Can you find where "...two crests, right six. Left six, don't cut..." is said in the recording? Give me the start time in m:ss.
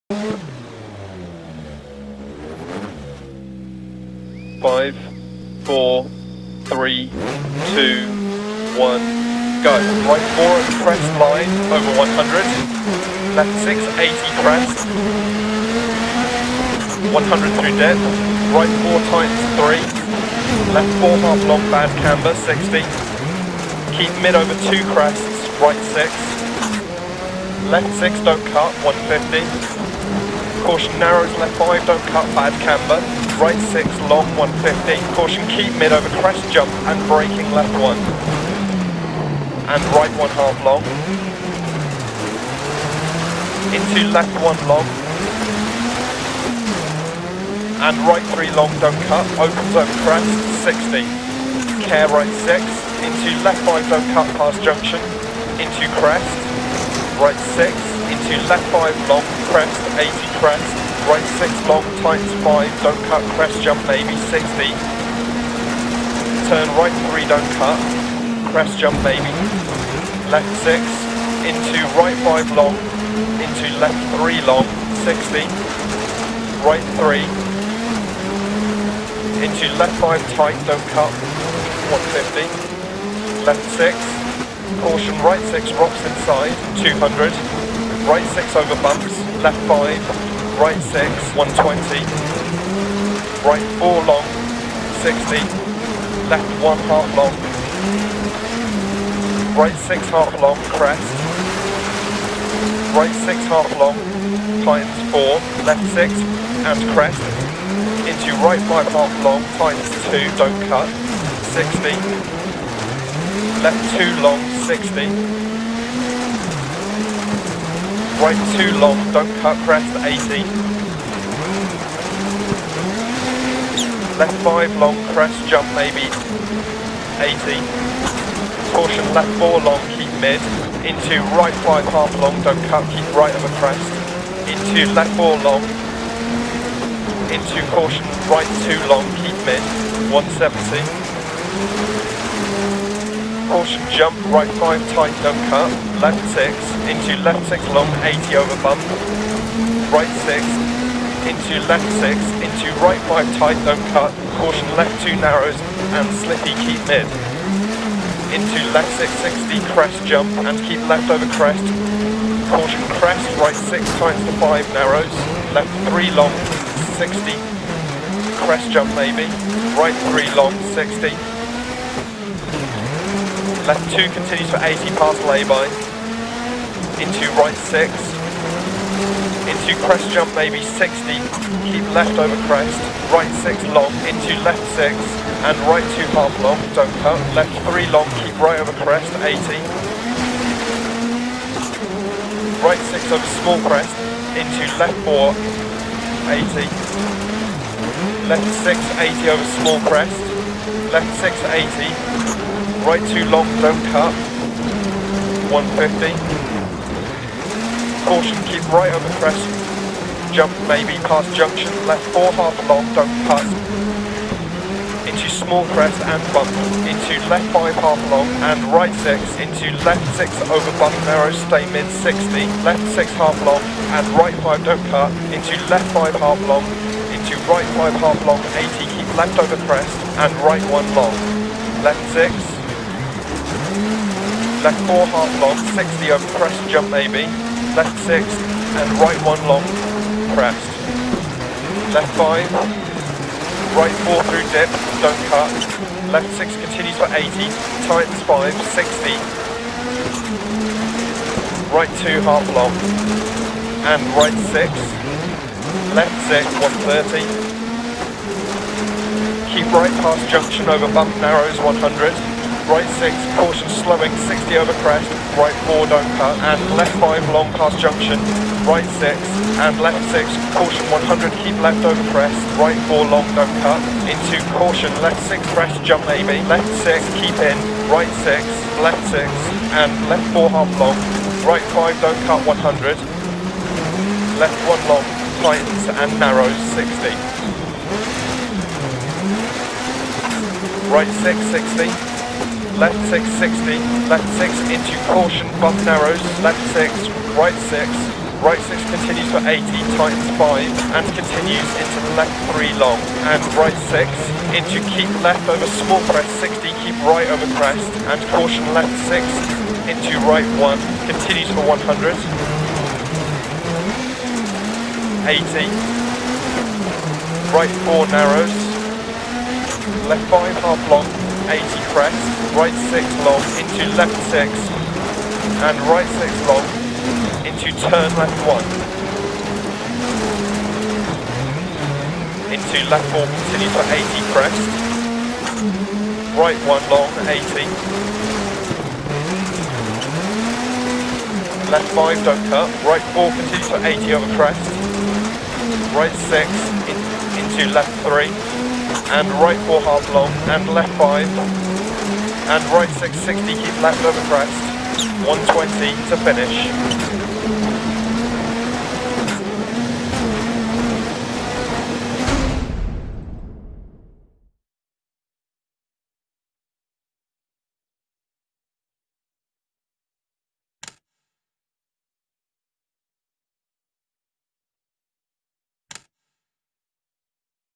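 0:24.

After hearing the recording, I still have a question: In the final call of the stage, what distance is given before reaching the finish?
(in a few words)
120.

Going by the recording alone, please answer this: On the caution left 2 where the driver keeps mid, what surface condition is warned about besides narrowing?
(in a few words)
slippy.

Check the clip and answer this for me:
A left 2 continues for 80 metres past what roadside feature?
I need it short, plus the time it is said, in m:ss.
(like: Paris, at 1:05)
lay-by, at 2:55.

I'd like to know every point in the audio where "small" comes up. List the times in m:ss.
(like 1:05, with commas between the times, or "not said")
3:13, 3:19, 3:35, 5:05.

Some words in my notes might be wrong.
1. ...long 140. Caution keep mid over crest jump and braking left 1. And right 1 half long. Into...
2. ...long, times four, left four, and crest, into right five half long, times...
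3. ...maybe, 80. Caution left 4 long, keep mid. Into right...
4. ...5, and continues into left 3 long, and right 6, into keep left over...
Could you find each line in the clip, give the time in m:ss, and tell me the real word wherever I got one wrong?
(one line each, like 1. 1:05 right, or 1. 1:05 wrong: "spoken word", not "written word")
1. 0:34 wrong: "150", not "140"
2. 1:43 wrong: "six", not "four"
3. 2:05 right
4. 5:00 right.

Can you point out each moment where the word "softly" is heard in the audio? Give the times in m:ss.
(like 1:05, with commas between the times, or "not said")
not said.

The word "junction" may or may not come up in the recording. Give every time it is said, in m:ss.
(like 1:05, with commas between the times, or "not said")
0:54, 3:31, 4:20, 4:27.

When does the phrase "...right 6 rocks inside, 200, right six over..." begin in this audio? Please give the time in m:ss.
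1:25.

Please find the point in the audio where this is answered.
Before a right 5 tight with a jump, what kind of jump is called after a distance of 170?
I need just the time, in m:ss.
2:23.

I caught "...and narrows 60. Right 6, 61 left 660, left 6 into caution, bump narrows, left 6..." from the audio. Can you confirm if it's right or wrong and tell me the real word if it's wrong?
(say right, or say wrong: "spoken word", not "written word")
wrong: "60", not "61".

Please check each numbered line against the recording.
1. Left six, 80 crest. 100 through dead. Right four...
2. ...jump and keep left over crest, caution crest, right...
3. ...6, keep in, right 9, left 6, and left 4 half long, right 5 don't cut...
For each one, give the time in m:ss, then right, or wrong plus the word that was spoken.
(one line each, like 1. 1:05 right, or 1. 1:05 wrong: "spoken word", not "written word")
1. 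0:13 right
2. 2:40 right
3. 4:36 wrong: "6", not "9".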